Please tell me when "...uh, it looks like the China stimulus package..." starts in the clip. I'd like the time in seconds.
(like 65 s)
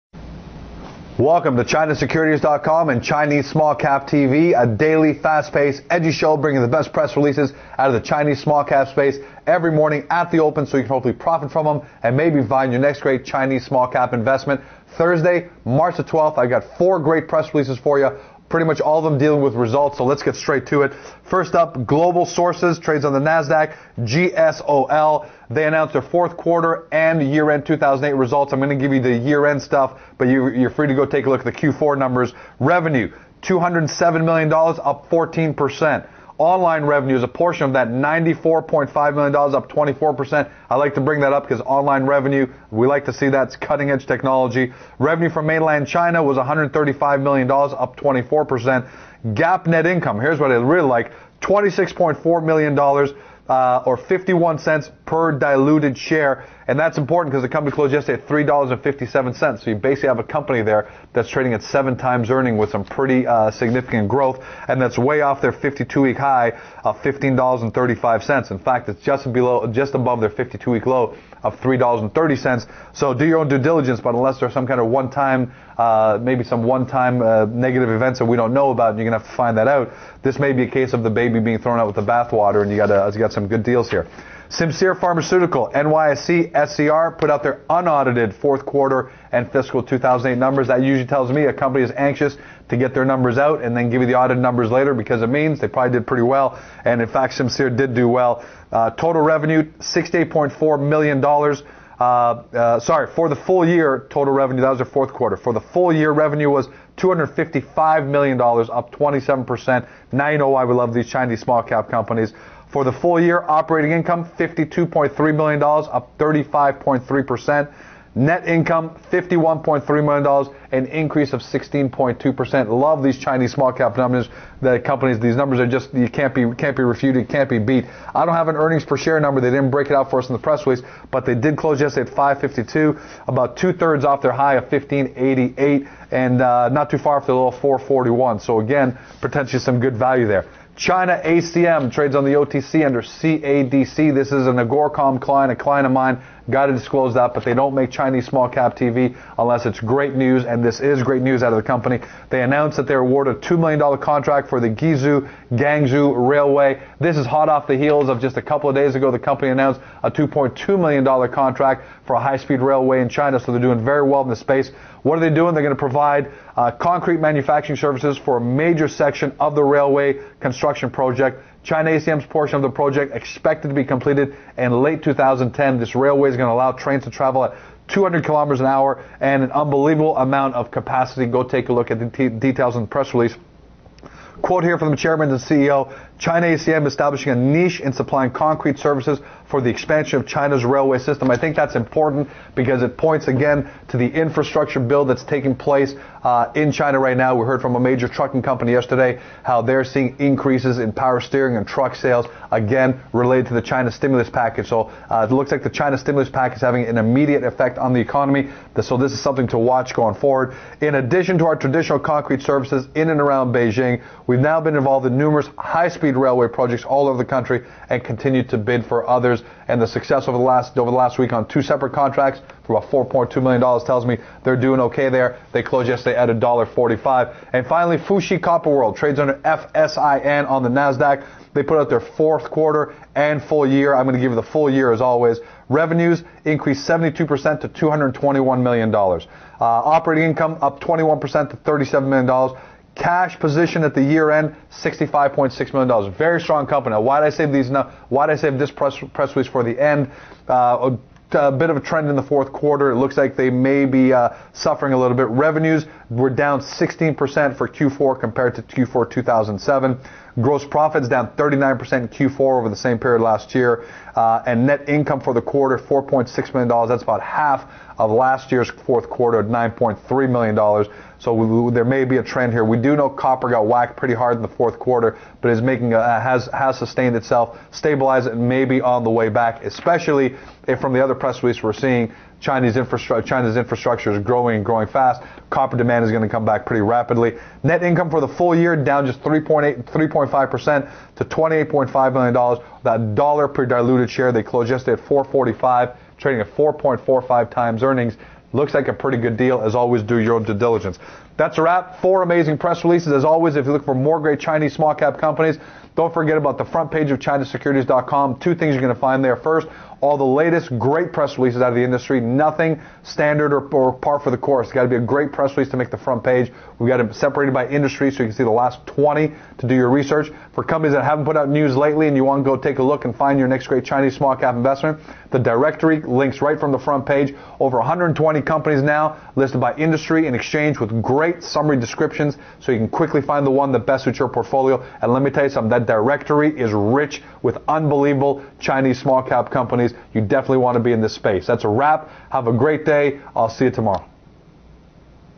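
205 s.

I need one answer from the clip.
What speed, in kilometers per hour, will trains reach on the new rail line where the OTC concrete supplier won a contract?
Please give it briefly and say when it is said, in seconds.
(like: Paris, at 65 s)
200 kilometers an hour, at 177 s.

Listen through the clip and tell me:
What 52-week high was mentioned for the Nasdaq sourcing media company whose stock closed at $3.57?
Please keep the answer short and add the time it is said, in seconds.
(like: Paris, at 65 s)
$15.35, at 66 s.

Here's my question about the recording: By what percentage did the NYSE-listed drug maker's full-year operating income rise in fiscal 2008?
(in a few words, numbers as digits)
35.3%.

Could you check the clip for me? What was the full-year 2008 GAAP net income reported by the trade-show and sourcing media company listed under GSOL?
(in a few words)
$26.4 million.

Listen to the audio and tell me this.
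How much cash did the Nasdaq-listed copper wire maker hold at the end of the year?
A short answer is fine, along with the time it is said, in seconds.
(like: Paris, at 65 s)
$65.6 million, at 244 s.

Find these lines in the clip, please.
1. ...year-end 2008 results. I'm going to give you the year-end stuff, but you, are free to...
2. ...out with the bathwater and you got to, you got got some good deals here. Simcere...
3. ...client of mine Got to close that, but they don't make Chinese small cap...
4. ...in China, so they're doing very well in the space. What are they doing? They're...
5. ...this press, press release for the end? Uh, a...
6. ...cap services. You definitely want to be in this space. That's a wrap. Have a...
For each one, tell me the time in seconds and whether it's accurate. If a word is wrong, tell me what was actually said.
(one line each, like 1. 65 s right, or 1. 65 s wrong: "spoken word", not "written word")
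1. 27 s right
2. 81 s right
3. 145 s wrong: "disclose", not "close"
4. 163 s right
5. 248 s right
6. 339 s wrong: "companies", not "services".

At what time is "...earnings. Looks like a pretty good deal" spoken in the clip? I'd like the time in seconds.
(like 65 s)
297 s.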